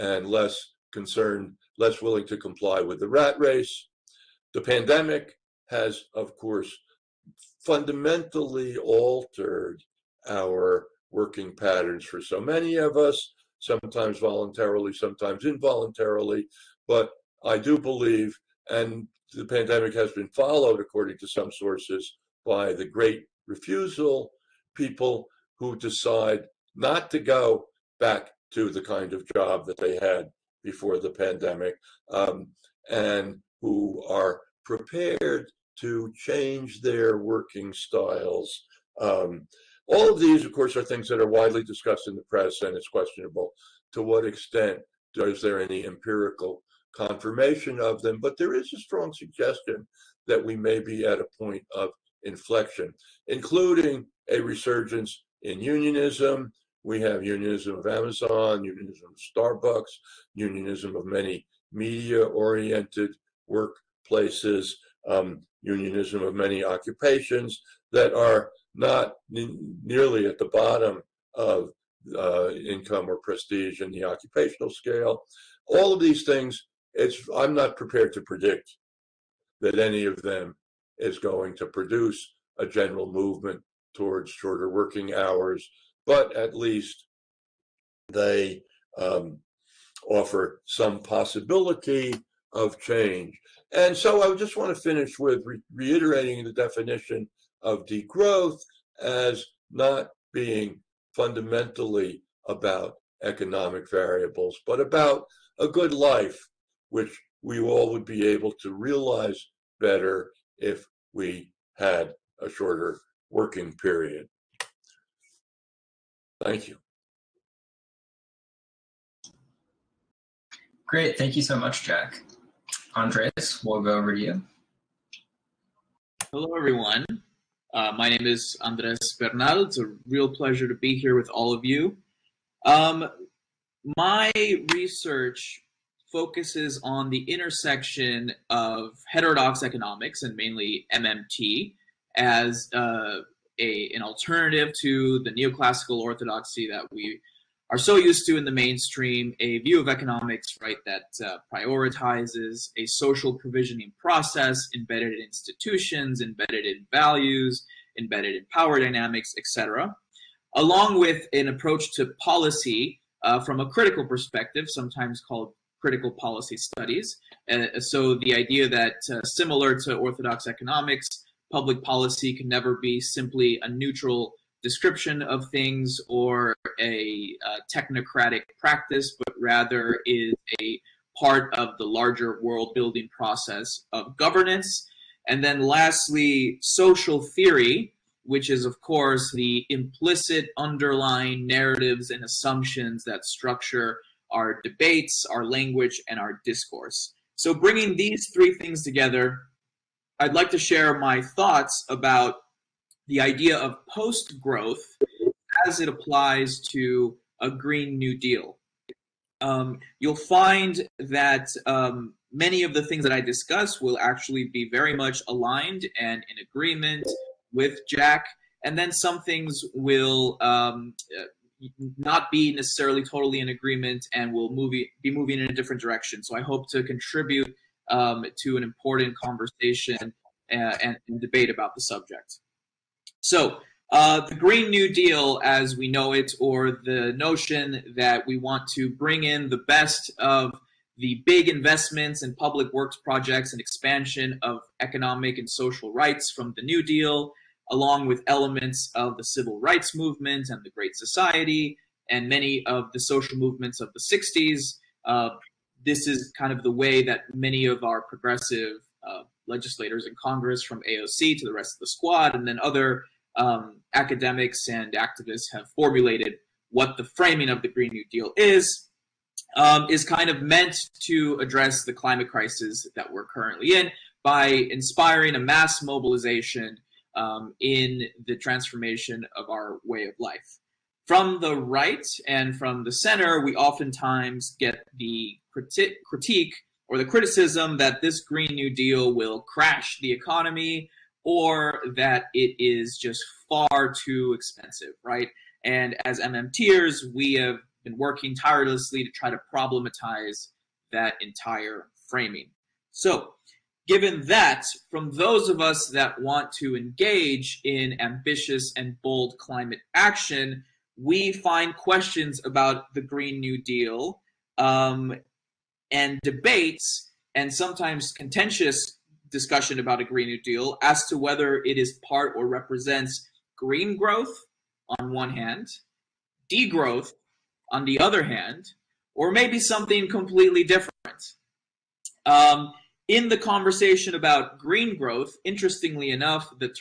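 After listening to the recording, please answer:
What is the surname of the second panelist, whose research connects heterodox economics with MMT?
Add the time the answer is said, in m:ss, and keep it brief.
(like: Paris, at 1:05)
Bernal, at 2:09.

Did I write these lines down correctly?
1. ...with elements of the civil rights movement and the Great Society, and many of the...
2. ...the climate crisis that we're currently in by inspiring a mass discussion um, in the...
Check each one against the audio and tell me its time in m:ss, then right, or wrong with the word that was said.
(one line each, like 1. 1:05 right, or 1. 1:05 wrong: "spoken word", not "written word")
1. 4:08 right
2. 4:31 wrong: "mobilization", not "discussion".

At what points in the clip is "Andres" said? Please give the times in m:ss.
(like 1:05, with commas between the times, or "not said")
2:02, 2:08.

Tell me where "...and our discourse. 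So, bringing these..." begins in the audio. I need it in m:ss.
3:16.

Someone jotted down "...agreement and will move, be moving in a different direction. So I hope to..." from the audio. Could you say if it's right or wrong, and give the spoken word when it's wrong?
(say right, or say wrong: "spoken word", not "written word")
right.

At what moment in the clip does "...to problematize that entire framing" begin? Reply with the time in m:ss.
4:59.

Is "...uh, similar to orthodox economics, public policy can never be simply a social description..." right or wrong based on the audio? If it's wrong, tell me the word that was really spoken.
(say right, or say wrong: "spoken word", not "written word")
wrong: "neutral", not "social".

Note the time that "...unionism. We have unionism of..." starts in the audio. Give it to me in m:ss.
0:55.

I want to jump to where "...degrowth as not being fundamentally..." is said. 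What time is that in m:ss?
1:37.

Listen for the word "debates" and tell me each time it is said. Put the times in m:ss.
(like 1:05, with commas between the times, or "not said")
3:14, 3:51, 5:16.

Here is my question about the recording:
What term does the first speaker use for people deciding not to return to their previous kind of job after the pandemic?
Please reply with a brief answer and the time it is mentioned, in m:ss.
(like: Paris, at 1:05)
the great refusal, at 0:22.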